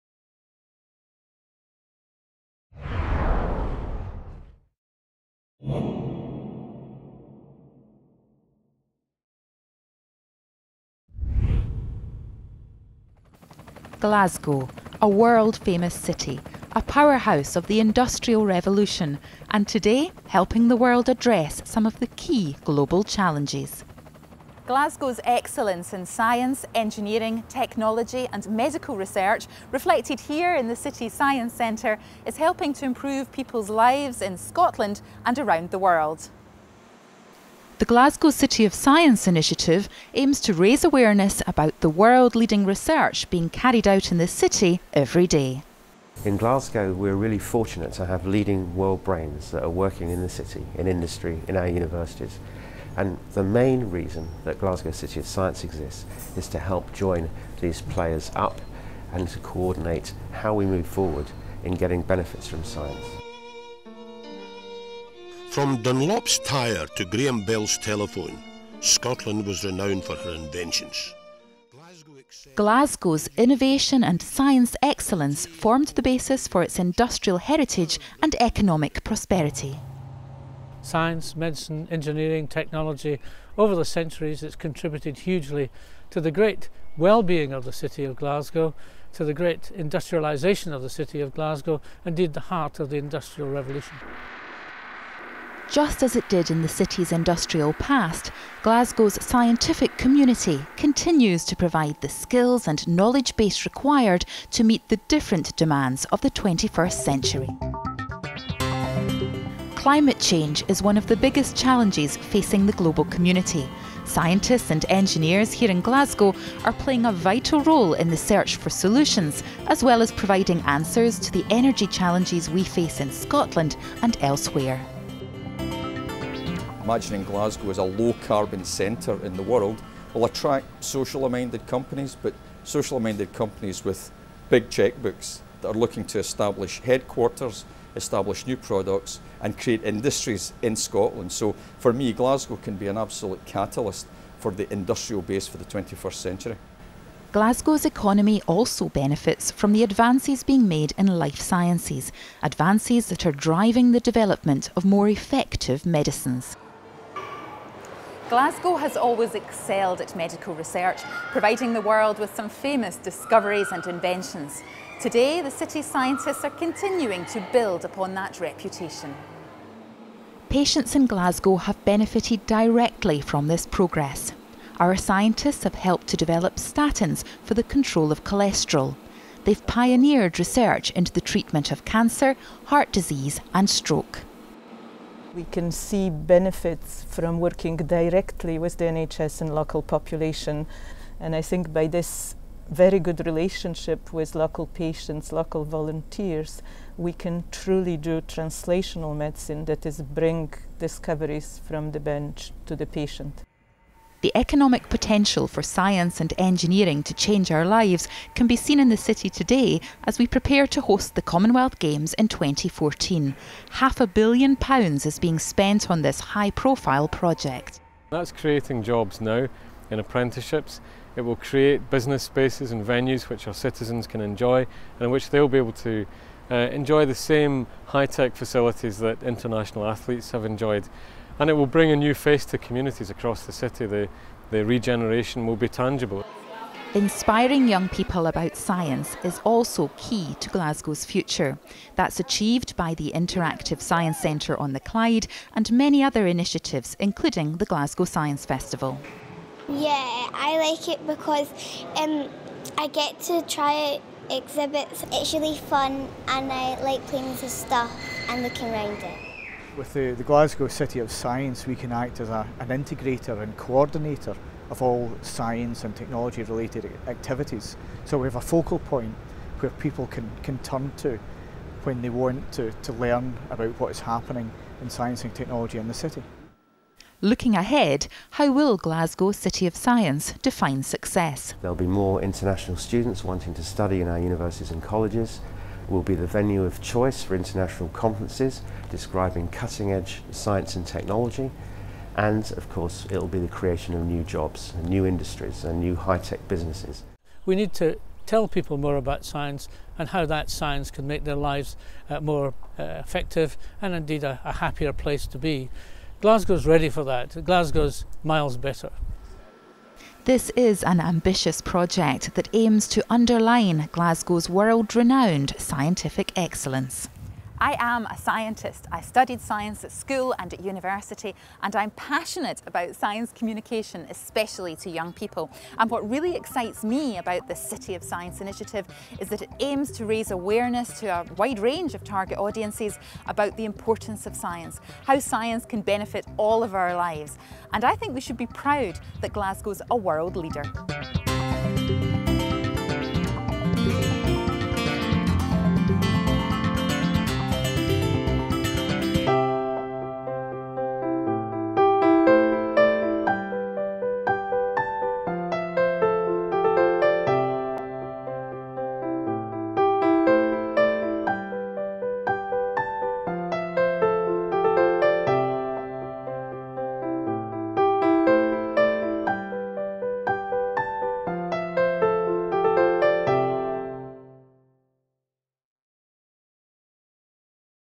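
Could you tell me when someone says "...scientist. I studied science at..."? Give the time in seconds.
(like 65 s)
318 s.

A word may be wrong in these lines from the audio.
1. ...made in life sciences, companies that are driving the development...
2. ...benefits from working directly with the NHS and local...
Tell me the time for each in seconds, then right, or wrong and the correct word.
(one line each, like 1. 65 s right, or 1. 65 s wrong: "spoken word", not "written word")
1. 150 s wrong: "advances", not "companies"
2. 186 s right.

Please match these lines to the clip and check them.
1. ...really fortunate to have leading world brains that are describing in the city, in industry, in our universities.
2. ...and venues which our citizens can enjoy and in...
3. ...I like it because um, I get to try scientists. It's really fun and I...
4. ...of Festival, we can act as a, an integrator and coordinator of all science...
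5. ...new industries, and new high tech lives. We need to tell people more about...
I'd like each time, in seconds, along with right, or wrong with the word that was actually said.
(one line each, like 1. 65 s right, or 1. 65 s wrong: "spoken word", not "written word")
1. 47 s wrong: "working", not "describing"
2. 222 s right
3. 250 s wrong: "exhibits", not "scientists"
4. 260 s wrong: "Science", not "Festival"
5. 294 s wrong: "businesses", not "lives".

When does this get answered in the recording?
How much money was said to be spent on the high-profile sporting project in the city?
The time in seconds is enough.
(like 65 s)
213 s.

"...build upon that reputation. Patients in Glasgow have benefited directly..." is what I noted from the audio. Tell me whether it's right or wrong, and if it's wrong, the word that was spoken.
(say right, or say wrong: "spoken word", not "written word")
right.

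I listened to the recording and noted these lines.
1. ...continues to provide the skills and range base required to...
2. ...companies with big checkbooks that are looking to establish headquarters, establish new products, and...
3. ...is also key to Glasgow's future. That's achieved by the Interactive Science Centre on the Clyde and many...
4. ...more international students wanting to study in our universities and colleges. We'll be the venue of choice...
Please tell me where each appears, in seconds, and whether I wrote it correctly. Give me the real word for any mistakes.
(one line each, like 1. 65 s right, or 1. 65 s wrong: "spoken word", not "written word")
1. 100 s wrong: "knowledge", not "range"
2. 133 s right
3. 239 s right
4. 281 s right.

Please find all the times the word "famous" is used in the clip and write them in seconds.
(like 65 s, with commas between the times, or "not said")
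15 s, 162 s.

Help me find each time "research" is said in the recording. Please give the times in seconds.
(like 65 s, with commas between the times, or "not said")
28 s, 42 s, 160 s, 180 s.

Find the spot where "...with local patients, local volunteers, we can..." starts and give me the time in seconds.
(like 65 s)
194 s.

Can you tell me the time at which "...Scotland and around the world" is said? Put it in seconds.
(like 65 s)
34 s.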